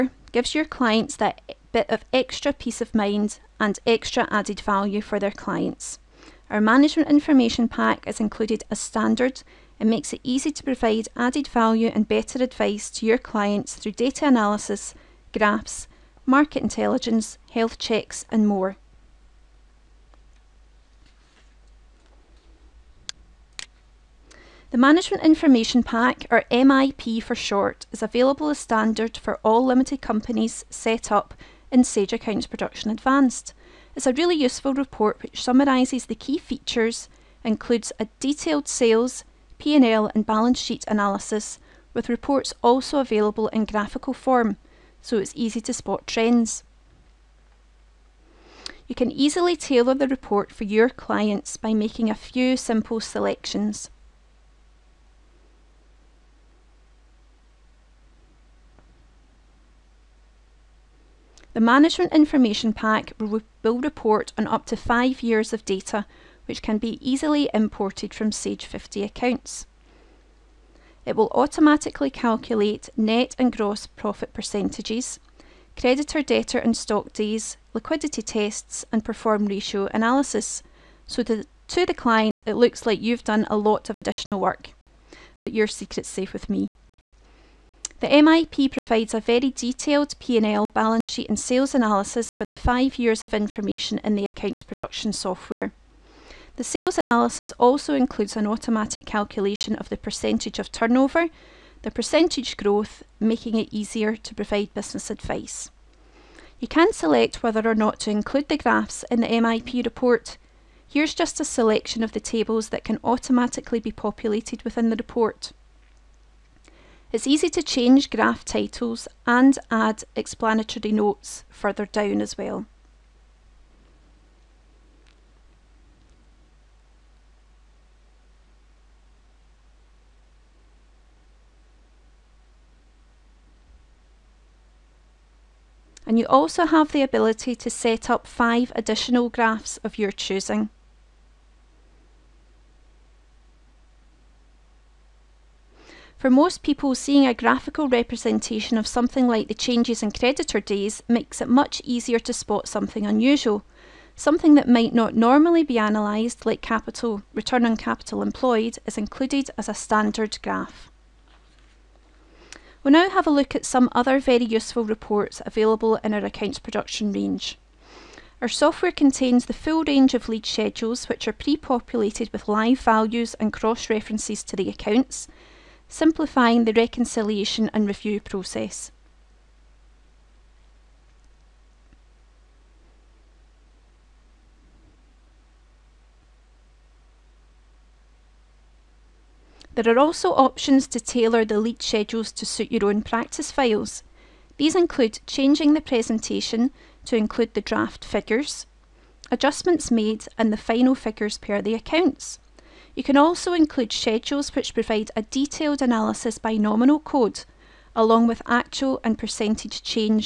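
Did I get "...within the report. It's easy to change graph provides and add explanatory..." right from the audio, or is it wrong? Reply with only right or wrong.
wrong.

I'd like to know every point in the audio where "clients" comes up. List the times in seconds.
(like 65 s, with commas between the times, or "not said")
0 s, 5 s, 13 s, 50 s, 81 s.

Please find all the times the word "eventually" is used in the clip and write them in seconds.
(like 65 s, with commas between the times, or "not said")
not said.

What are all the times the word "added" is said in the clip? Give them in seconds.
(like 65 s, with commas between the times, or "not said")
4 s, 11 s.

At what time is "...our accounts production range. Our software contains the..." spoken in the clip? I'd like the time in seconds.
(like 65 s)
166 s.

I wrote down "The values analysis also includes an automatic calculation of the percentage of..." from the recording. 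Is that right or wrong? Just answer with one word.
wrong.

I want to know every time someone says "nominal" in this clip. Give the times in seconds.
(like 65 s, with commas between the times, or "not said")
206 s.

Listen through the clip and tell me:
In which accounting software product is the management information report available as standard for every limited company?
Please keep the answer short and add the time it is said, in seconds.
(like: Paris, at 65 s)
Sage Accounts Production Advanced, at 31 s.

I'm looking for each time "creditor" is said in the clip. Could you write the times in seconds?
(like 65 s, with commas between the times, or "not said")
75 s, 150 s.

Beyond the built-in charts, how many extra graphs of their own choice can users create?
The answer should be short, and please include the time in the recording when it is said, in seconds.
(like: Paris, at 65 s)
5, at 138 s.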